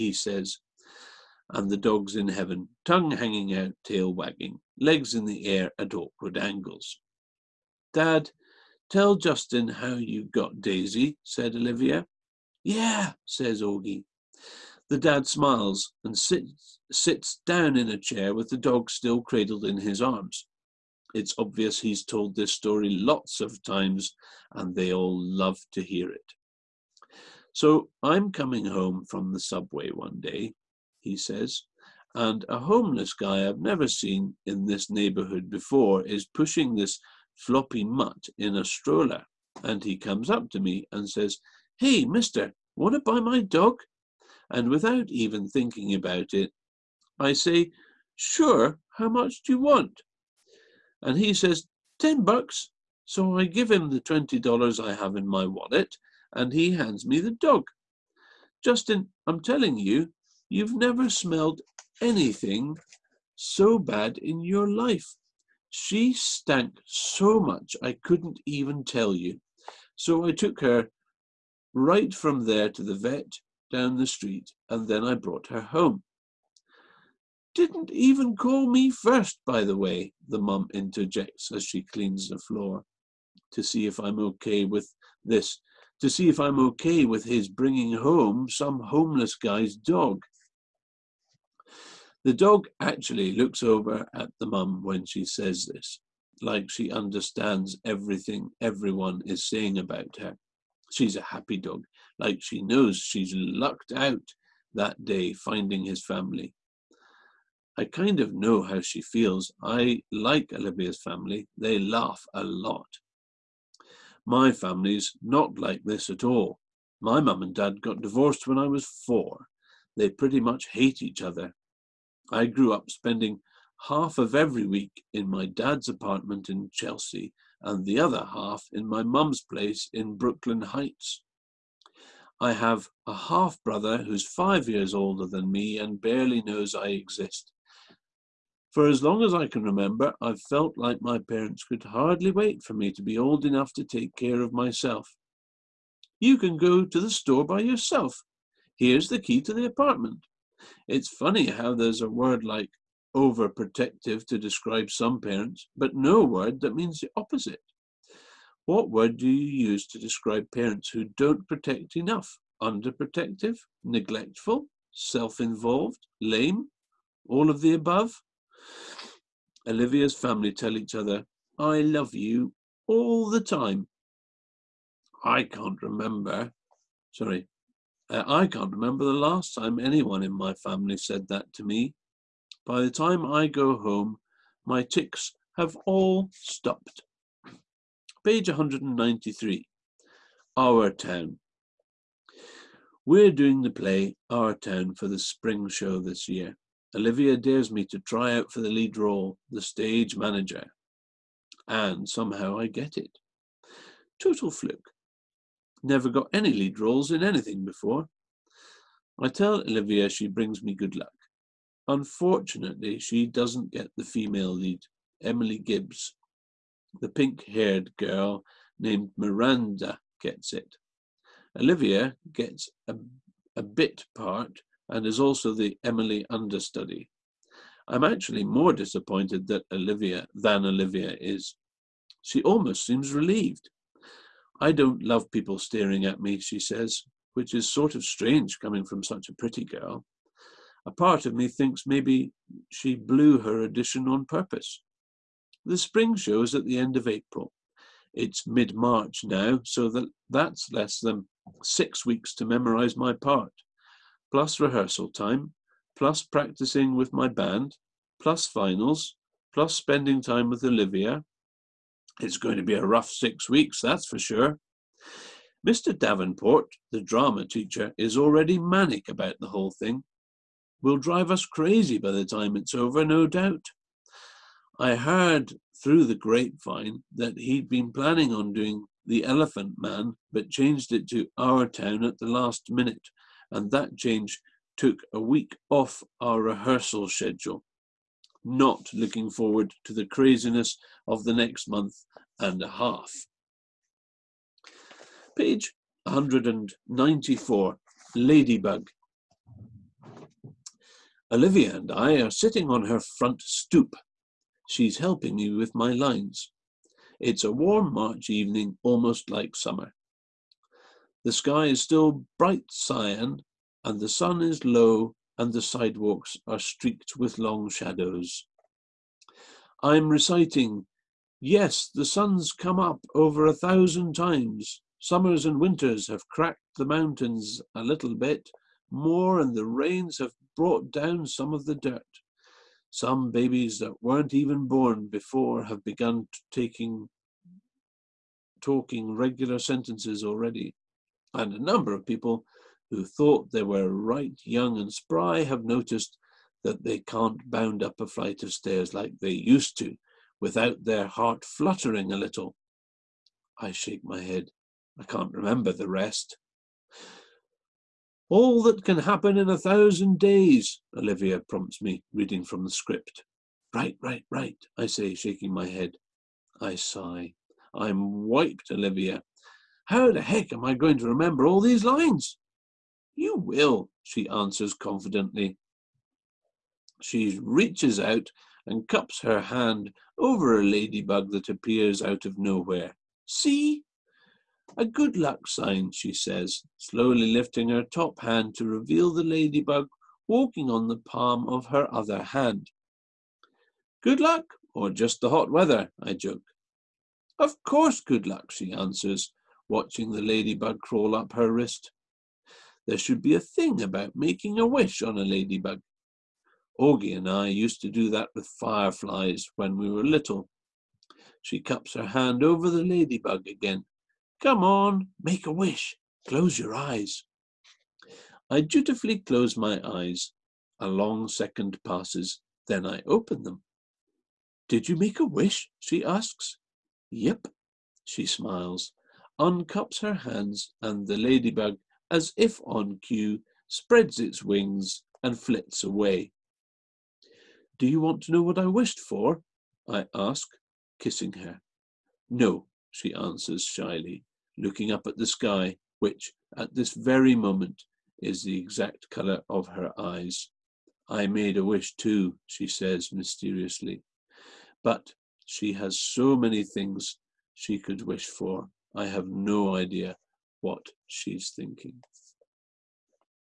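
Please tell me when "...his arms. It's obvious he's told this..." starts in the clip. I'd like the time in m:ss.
0:19.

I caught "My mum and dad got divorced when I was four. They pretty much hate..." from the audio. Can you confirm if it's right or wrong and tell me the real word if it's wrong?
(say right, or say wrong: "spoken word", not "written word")
right.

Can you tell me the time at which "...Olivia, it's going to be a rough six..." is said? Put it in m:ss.
4:20.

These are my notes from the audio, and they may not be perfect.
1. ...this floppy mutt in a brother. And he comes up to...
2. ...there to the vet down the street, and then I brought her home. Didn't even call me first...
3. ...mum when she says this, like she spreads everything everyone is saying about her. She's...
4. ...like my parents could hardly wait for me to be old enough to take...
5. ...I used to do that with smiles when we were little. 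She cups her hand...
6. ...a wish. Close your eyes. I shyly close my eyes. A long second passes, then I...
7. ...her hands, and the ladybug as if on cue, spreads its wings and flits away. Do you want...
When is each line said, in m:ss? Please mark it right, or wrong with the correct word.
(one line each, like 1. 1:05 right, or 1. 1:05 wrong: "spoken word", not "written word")
1. 0:36 wrong: "stroller", not "brother"
2. 1:12 right
3. 1:34 wrong: "understands", not "spreads"
4. 2:20 right
5. 6:47 wrong: "fireflies", not "smiles"
6. 6:55 wrong: "dutifully", not "shyly"
7. 7:10 right.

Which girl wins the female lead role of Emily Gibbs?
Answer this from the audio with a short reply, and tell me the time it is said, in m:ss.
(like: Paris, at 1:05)
Miranda, at 3:39.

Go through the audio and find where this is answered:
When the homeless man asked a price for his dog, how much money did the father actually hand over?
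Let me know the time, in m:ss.
0:54.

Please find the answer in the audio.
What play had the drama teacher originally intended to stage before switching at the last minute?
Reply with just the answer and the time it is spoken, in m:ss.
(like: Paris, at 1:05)
The Elephant Man, at 4:39.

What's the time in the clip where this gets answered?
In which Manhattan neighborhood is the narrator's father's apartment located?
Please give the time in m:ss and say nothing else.
2:06.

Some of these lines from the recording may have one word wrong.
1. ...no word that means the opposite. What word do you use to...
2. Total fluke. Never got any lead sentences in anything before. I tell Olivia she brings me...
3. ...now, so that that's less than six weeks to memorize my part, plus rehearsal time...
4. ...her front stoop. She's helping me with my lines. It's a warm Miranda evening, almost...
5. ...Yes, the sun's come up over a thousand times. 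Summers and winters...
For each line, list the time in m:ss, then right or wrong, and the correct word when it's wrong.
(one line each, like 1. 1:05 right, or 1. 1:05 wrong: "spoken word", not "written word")
1. 2:35 right
2. 3:24 wrong: "roles", not "sentences"
3. 4:09 right
4. 5:02 wrong: "March", not "Miranda"
5. 5:21 right.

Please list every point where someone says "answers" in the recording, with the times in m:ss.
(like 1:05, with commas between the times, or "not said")
6:14, 6:38, 7:23.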